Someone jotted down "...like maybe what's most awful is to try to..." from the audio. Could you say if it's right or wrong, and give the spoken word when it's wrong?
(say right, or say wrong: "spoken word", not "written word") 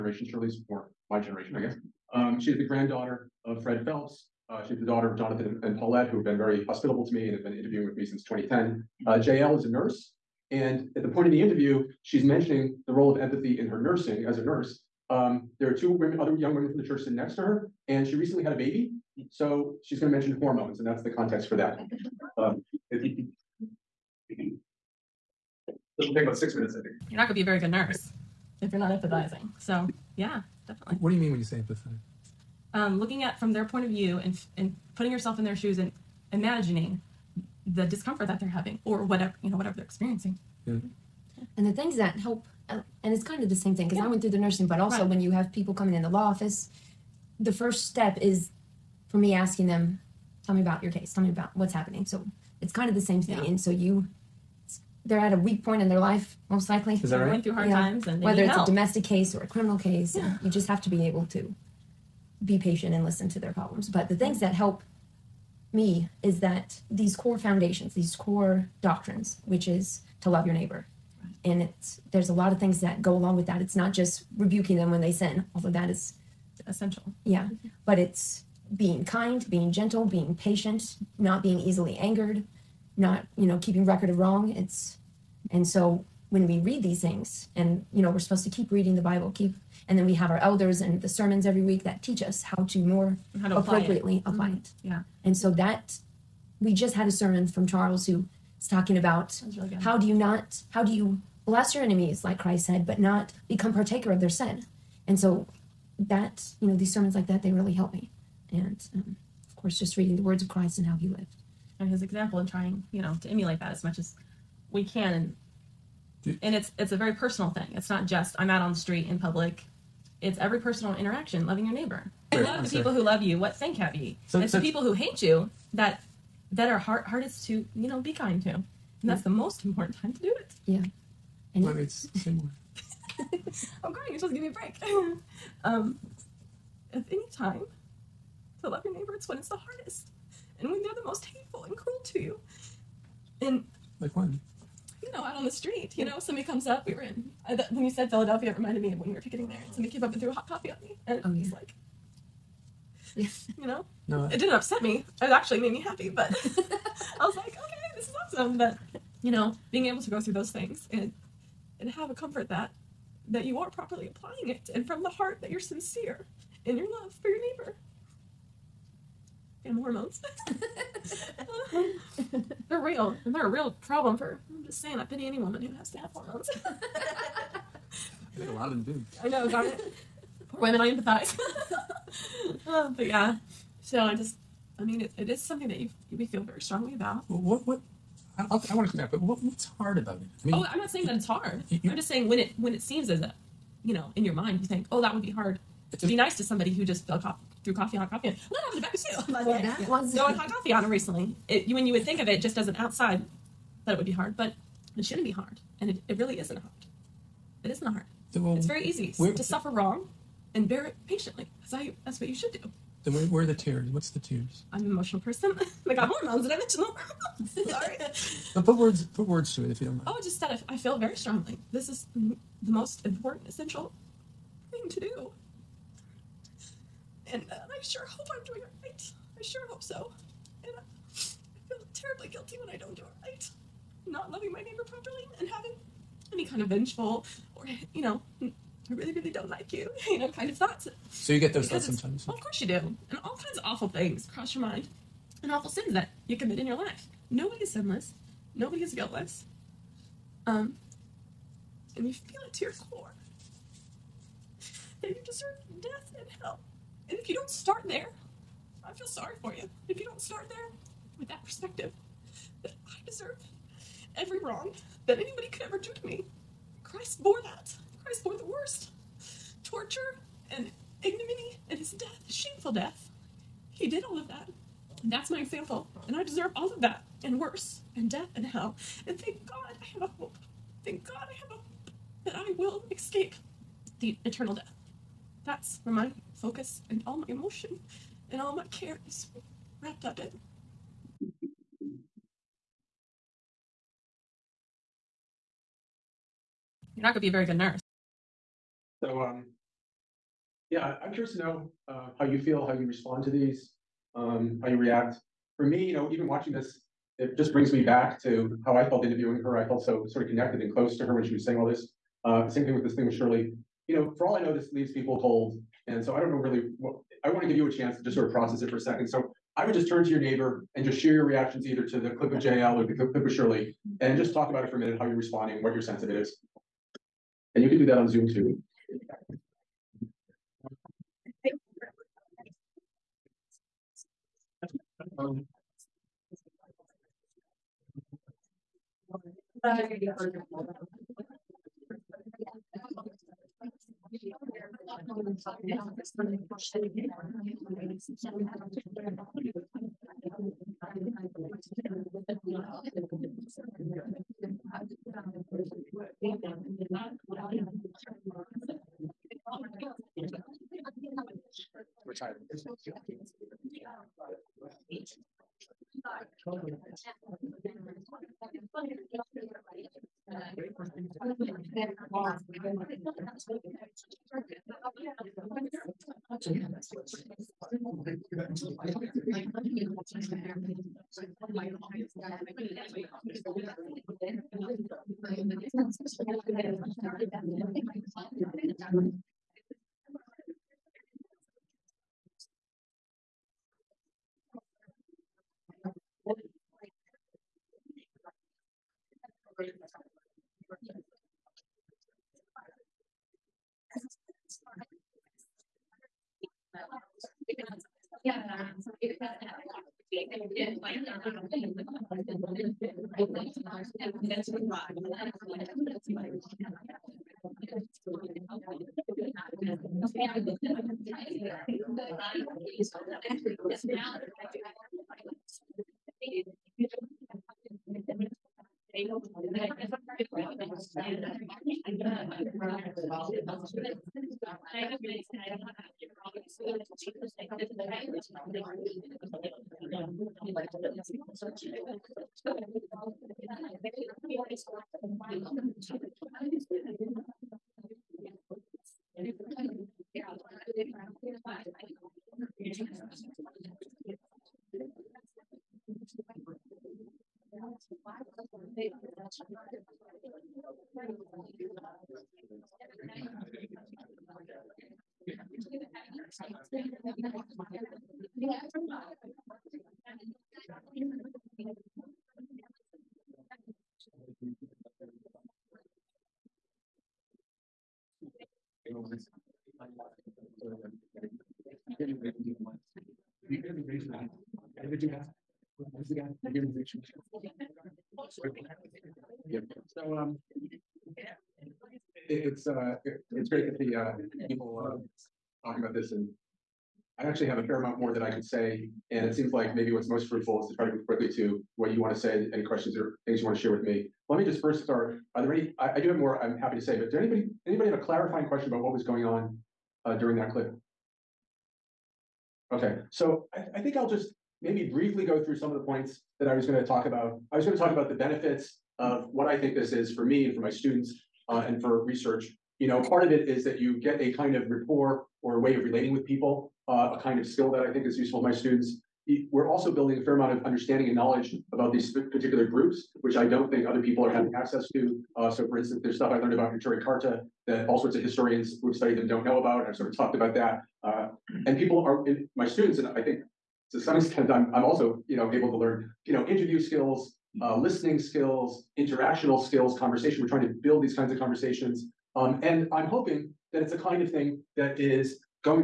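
wrong: "fruitful", not "awful".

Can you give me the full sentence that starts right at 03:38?
but put words put words to it if you don't mind.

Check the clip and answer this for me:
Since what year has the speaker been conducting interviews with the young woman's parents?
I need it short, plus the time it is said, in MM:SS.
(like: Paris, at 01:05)
2010, at 00:08.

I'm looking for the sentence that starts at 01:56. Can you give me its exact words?
And and it's it's a very personal thing.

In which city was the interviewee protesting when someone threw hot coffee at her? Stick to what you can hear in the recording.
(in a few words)
Philadelphia.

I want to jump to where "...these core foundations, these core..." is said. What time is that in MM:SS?
01:06.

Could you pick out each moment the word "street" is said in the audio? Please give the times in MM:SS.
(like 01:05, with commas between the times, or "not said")
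01:58, 02:25.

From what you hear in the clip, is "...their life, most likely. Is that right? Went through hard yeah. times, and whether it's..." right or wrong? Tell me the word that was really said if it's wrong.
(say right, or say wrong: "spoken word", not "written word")
right.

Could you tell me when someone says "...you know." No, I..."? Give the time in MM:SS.
02:33.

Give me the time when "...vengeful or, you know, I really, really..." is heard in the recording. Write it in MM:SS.
03:56.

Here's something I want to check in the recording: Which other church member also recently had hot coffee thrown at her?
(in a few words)
Becca.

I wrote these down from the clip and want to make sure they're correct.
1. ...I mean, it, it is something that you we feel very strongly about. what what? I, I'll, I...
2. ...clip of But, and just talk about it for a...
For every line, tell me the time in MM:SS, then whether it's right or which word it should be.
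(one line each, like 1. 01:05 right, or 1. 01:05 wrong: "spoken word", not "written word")
1. 03:04 right
2. 05:22 wrong: "Shirley", not "But".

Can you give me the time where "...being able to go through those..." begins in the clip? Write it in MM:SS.
02:39.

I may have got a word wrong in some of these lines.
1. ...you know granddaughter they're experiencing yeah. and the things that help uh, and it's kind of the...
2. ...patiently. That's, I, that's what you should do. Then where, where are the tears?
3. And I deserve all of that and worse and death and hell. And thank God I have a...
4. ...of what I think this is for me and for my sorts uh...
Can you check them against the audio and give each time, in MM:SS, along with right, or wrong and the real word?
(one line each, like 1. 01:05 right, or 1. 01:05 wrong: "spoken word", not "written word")
1. 00:39 wrong: "whatever", not "granddaughter"
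2. 03:31 right
3. 04:36 right
4. 08:38 wrong: "students", not "sorts".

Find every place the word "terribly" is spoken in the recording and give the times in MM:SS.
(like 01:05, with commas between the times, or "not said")
03:51.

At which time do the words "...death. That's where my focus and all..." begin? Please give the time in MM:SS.
04:44.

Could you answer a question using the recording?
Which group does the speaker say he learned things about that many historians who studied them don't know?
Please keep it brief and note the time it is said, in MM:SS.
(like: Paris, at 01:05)
Neturei Karta, at 08:56.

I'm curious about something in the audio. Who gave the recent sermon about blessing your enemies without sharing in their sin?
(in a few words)
Charles.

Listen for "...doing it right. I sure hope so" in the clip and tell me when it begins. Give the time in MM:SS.
03:48.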